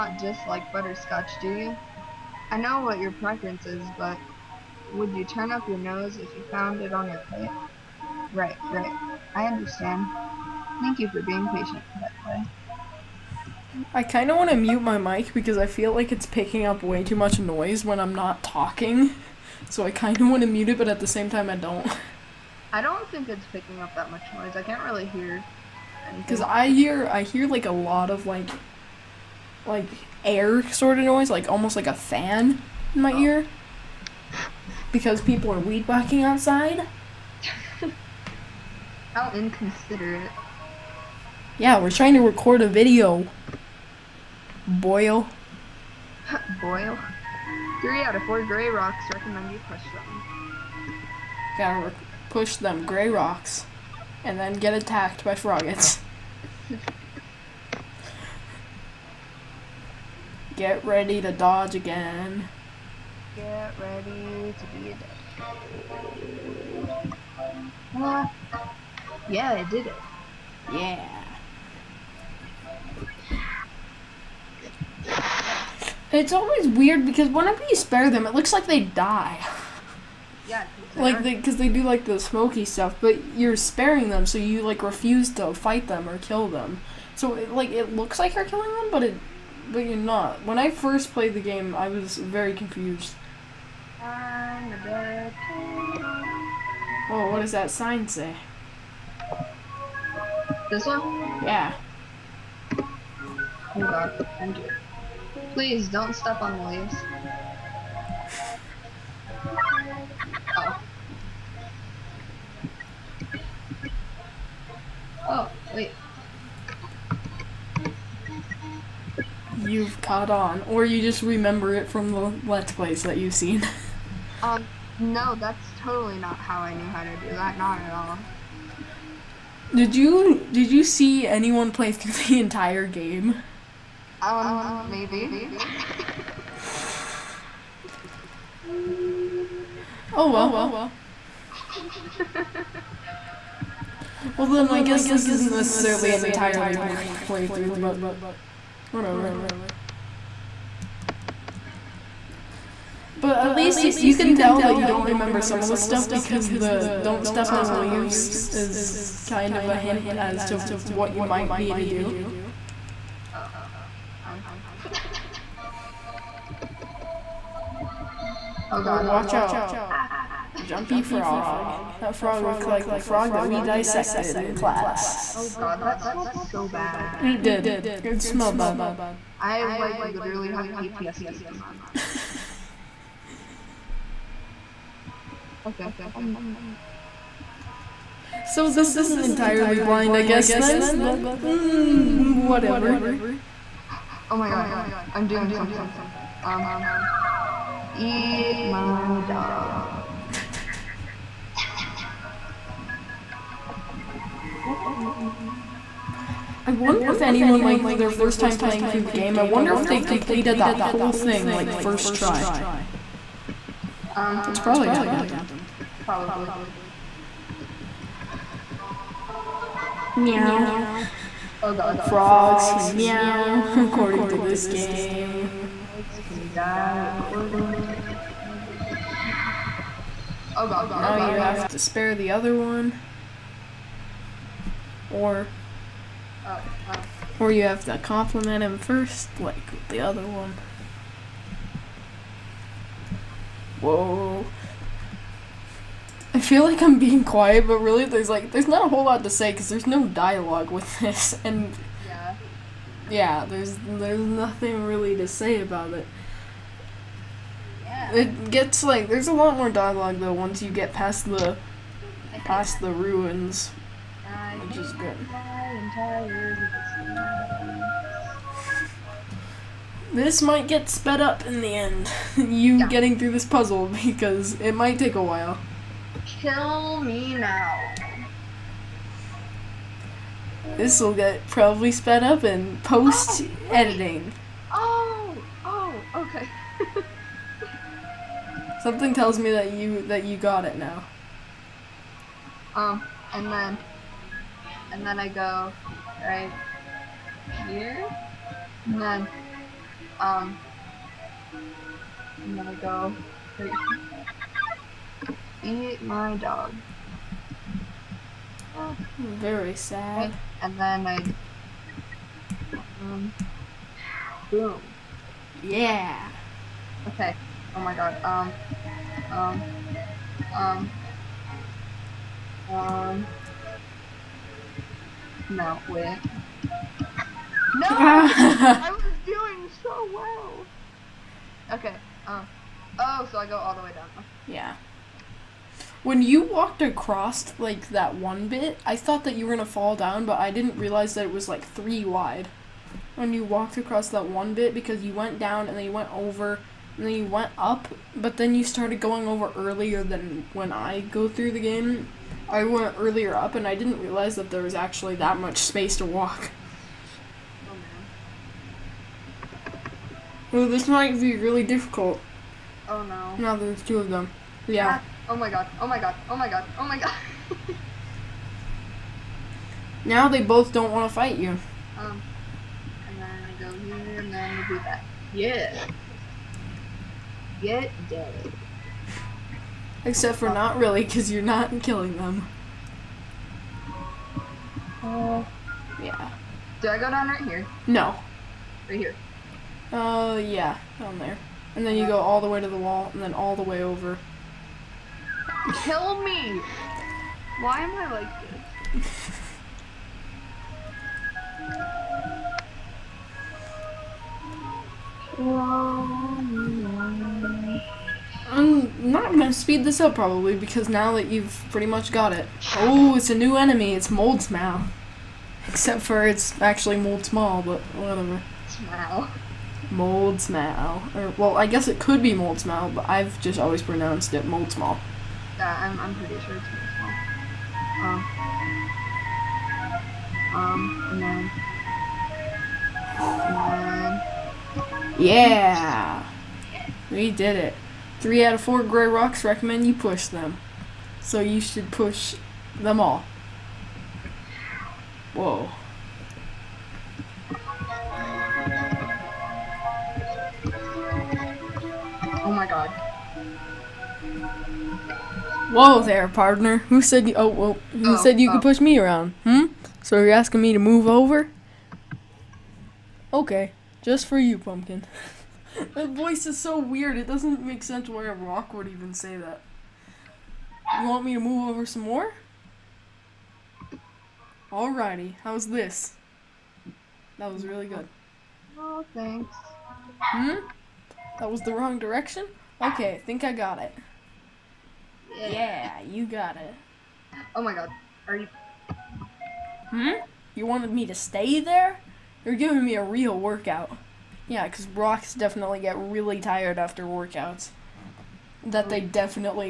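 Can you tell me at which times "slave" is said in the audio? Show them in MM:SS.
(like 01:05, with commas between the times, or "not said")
not said.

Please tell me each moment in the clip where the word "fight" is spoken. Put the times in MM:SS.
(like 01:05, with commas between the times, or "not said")
01:25, 06:11.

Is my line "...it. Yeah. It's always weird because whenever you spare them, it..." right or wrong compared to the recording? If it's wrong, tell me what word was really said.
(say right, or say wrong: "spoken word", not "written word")
right.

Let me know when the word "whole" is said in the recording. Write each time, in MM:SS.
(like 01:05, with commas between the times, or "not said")
03:30, 04:08.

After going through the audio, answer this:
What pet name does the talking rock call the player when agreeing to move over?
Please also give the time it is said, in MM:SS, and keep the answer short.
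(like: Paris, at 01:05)
Pumpkin, at 07:44.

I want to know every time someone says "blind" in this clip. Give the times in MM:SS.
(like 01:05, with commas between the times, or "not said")
02:26, 03:09.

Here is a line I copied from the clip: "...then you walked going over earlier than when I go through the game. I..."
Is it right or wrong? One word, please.
wrong.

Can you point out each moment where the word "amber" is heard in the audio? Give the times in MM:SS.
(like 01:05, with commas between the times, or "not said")
not said.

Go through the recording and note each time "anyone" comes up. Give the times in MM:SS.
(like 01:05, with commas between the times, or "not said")
02:11, 03:27.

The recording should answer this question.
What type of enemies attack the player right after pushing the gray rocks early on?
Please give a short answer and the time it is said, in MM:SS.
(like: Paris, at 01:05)
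Froggits, at 00:55.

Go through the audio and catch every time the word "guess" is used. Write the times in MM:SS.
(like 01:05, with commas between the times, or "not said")
02:24, 03:10, 07:01.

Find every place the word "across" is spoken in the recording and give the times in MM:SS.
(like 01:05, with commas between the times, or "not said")
05:36, 05:43.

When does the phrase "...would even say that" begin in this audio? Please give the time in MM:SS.
07:48.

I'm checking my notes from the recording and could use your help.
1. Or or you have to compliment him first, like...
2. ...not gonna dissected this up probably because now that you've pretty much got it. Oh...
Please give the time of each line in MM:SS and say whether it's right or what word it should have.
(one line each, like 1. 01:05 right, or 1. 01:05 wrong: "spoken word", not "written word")
1. 03:55 right
2. 06:49 wrong: "speed", not "dissected".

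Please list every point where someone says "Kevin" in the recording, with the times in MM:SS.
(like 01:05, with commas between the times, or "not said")
not said.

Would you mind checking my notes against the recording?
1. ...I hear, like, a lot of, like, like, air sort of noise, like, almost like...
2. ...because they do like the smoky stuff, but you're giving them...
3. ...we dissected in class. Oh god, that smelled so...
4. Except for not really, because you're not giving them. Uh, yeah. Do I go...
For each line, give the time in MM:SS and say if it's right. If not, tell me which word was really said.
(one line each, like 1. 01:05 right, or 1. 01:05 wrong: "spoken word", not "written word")
1. 00:27 right
2. 01:21 wrong: "sparing", not "giving"
3. 02:53 right
4. 06:20 wrong: "killing", not "giving".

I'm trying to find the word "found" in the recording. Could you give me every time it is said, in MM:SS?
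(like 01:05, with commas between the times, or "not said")
00:06.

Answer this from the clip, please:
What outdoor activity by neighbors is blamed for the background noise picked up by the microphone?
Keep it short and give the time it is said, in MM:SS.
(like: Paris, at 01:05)
Weed whacking, at 00:35.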